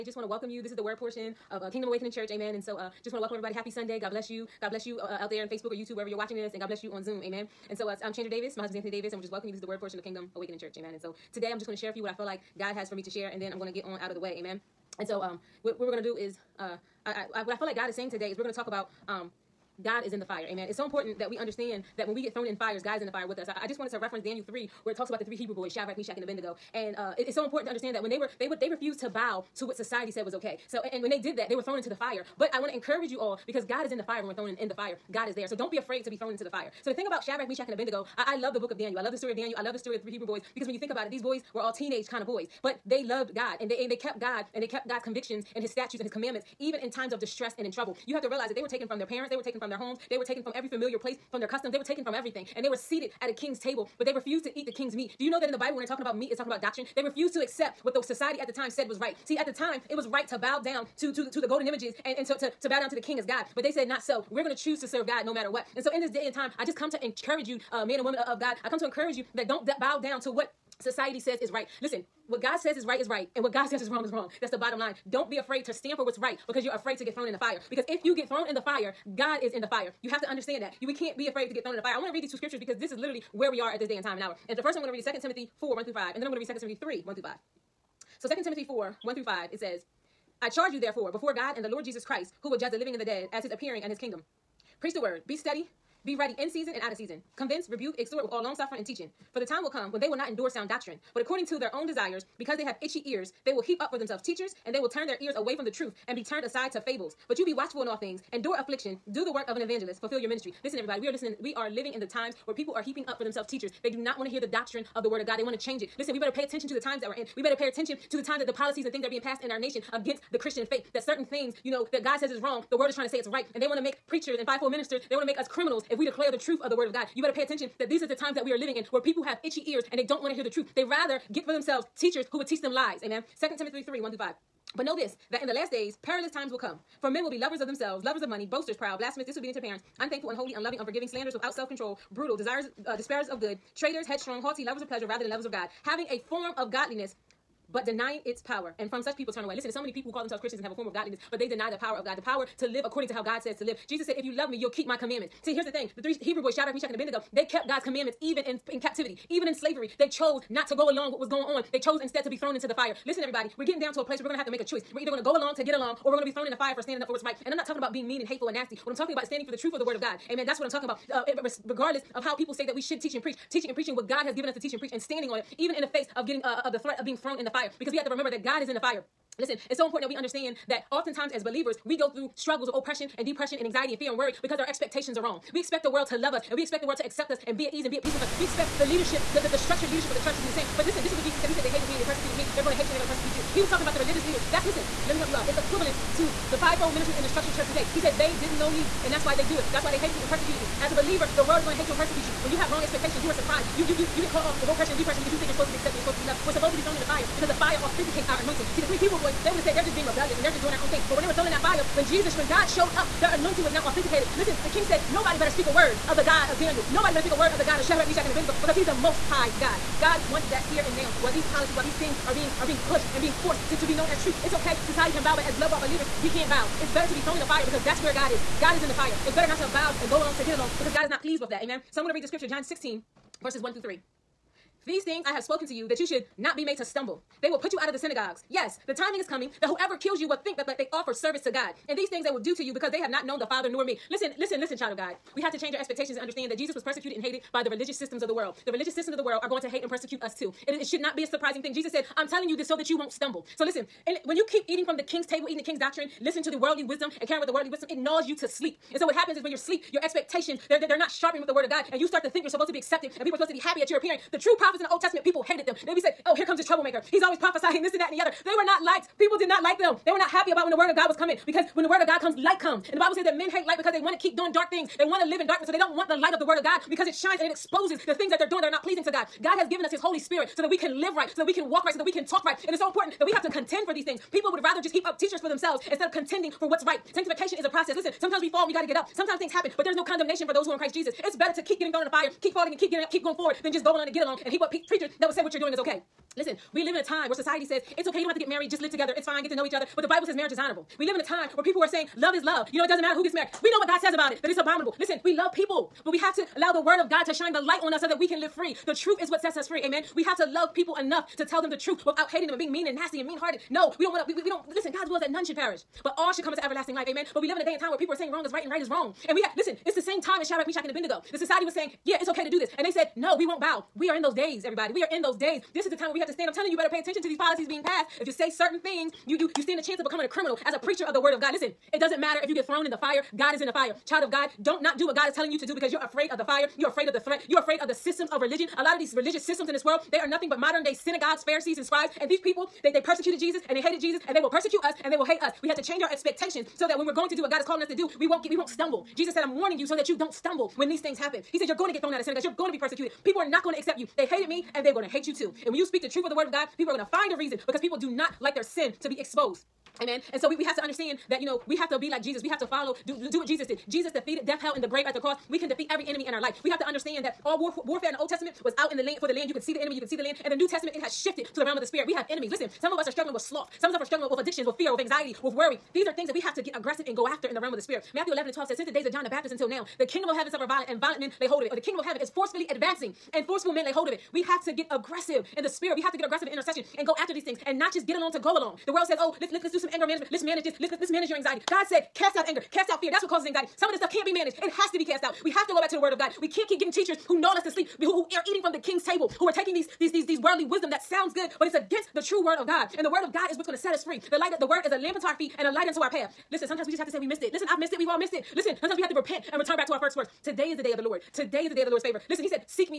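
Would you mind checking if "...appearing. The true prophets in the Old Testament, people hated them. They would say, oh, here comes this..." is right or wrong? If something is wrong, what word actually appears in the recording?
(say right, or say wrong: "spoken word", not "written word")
right.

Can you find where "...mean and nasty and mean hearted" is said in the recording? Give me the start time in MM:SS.
05:12.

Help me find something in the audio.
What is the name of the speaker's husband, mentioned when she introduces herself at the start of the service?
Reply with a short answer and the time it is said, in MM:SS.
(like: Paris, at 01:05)
Anthony Davis, at 00:08.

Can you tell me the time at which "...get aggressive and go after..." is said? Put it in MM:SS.
06:16.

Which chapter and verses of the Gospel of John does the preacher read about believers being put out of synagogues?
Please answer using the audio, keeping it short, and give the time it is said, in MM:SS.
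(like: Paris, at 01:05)
John 16:1-3, at 03:52.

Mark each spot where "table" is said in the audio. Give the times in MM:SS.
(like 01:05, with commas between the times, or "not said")
00:53, 04:15, 06:39.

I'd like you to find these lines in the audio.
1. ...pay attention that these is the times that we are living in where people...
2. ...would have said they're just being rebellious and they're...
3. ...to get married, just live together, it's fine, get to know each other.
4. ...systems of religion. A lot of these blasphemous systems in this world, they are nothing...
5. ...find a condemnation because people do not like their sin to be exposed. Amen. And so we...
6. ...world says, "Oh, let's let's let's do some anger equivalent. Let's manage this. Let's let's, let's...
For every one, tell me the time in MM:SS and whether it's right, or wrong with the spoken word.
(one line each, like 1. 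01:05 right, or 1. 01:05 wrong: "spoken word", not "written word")
1. 02:07 right
2. 03:29 right
3. 04:58 right
4. 05:37 wrong: "religious", not "blasphemous"
5. 05:57 wrong: "reason", not "condemnation"
6. 06:28 wrong: "management", not "equivalent".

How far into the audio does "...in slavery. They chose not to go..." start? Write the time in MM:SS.
02:39.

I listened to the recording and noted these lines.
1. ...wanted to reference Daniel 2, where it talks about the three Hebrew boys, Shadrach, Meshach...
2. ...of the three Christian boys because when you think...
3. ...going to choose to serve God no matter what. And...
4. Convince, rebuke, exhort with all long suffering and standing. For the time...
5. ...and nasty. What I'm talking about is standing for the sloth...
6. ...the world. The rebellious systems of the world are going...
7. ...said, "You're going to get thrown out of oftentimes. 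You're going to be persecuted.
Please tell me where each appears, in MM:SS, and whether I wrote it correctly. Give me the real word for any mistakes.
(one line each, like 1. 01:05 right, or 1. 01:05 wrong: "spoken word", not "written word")
1. 00:23 wrong: "3", not "2"
2. 00:39 wrong: "Hebrew", not "Christian"
3. 01:04 right
4. 01:37 wrong: "teaching", not "standing"
5. 02:48 wrong: "truth", not "sloth"
6. 04:08 wrong: "religious", not "rebellious"
7. 05:51 wrong: "synagogues", not "oftentimes".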